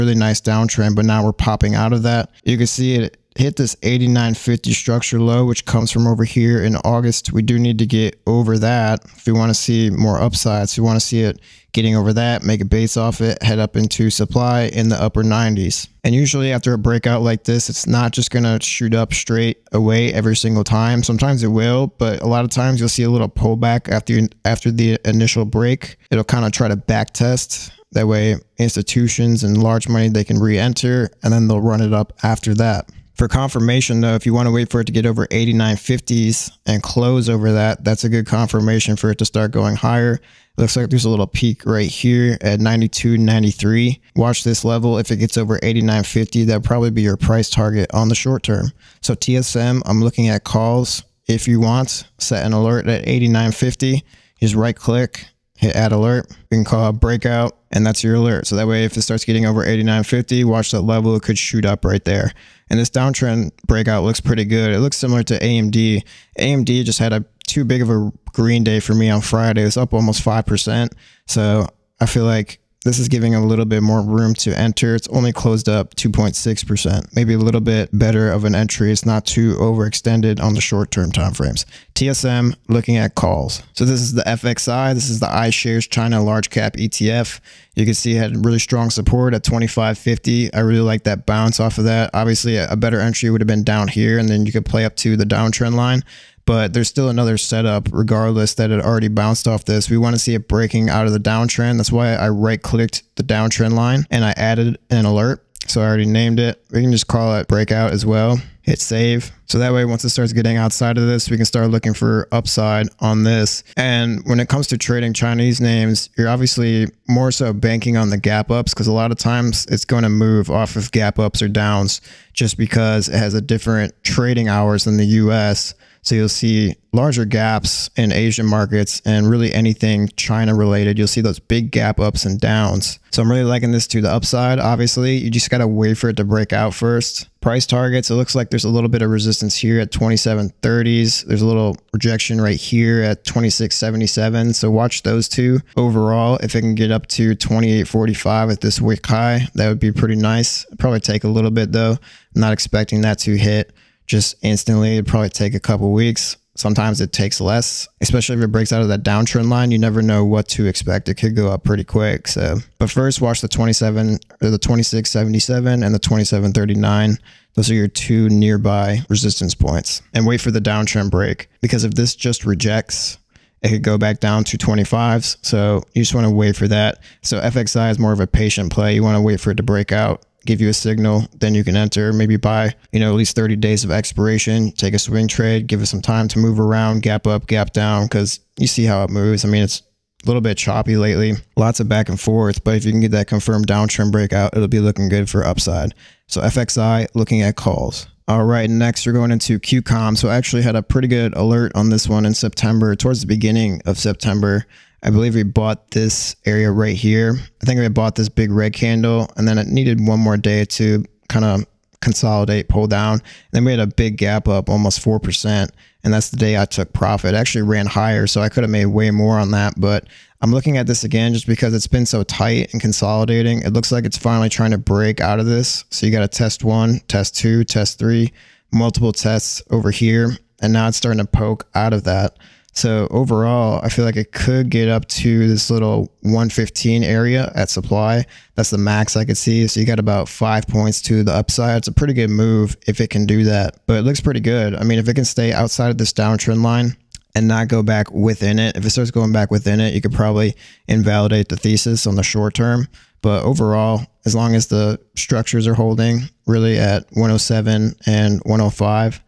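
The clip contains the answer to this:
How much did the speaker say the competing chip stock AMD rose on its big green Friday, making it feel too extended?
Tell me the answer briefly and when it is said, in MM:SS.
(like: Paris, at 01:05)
almost 5%, at 01:09.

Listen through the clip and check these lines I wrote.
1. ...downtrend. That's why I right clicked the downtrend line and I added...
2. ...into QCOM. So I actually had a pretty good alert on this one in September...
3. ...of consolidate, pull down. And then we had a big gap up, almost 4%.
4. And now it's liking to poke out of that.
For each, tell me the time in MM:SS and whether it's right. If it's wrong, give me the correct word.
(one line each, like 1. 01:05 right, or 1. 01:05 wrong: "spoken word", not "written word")
1. 01:41 right
2. 03:19 right
3. 03:31 right
4. 03:50 wrong: "starting", not "liking".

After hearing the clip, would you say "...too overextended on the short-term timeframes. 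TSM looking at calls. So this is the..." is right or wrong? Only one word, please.
right.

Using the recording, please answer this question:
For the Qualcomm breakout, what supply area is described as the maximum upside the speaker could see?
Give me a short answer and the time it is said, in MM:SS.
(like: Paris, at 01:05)
115, at 03:56.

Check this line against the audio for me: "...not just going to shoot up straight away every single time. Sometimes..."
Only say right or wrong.
right.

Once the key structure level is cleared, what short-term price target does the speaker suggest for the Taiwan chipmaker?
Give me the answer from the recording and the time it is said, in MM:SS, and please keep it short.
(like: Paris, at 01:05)
92.93, at 00:42.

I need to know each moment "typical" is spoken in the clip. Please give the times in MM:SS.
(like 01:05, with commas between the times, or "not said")
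not said.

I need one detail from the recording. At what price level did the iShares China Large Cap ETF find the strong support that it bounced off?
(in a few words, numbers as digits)
25.50.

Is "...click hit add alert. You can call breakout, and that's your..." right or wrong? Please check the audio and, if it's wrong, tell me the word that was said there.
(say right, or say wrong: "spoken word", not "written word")
right.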